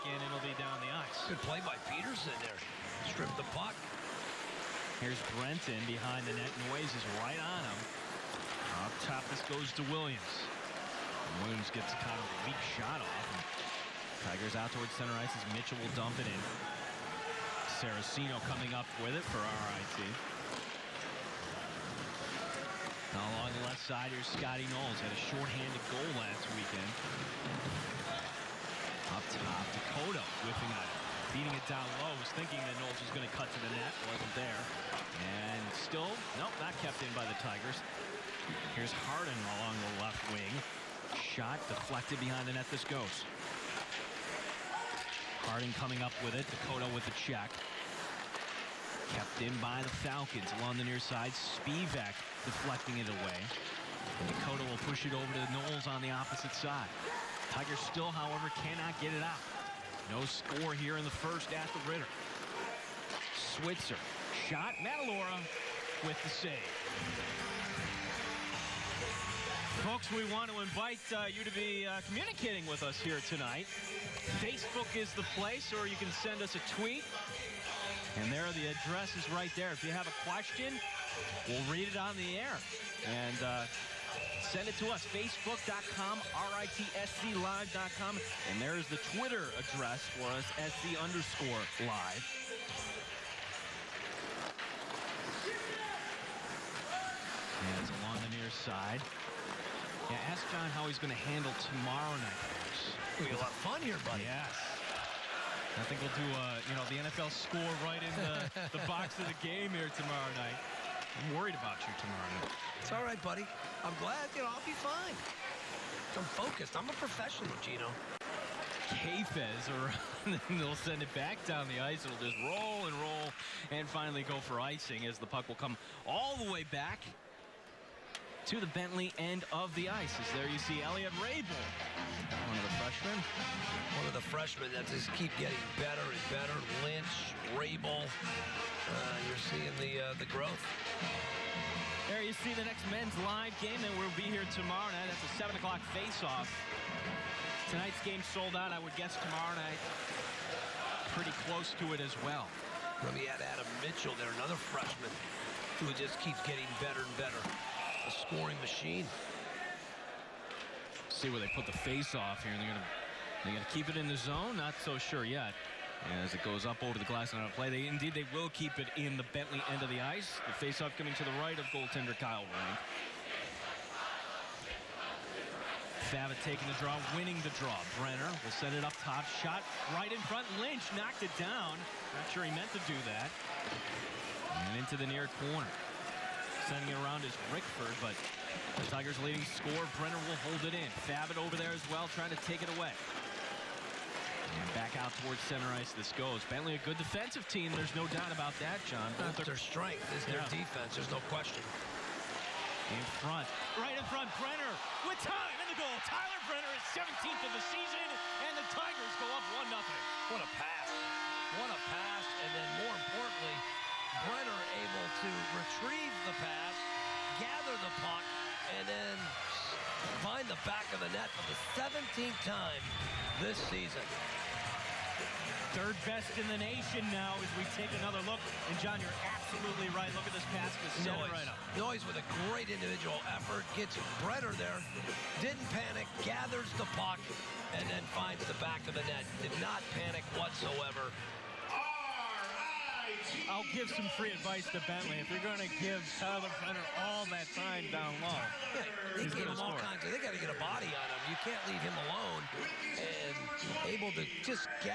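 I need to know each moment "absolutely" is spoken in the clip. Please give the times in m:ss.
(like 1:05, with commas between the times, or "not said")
3:49.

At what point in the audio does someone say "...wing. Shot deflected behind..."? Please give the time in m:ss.
0:40.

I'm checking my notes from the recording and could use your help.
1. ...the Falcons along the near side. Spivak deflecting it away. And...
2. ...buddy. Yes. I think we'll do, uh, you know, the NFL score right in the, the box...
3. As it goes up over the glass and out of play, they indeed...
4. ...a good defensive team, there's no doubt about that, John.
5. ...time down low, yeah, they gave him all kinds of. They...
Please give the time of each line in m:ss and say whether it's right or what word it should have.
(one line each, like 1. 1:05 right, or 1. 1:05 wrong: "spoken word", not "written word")
1. 0:49 right
2. 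1:44 right
3. 2:46 right
4. 3:16 right
5. 4:07 right.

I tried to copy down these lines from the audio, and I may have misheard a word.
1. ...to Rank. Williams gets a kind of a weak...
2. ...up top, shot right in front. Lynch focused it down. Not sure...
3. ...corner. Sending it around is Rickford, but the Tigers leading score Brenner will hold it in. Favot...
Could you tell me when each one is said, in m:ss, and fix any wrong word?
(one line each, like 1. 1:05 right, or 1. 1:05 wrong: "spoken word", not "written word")
1. 0:09 wrong: "Williams", not "Rank"
2. 2:58 wrong: "knocked", not "focused"
3. 3:05 right.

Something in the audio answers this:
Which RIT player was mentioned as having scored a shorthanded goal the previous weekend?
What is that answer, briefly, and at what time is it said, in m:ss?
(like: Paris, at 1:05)
Scotty Knowles, at 0:24.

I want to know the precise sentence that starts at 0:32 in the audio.
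Was thinking that Knowles was going to cut to the net.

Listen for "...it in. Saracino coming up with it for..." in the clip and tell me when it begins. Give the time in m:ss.
0:16.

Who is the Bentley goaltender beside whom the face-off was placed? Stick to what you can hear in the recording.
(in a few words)
Kyle Rank.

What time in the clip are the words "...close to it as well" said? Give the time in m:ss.
2:31.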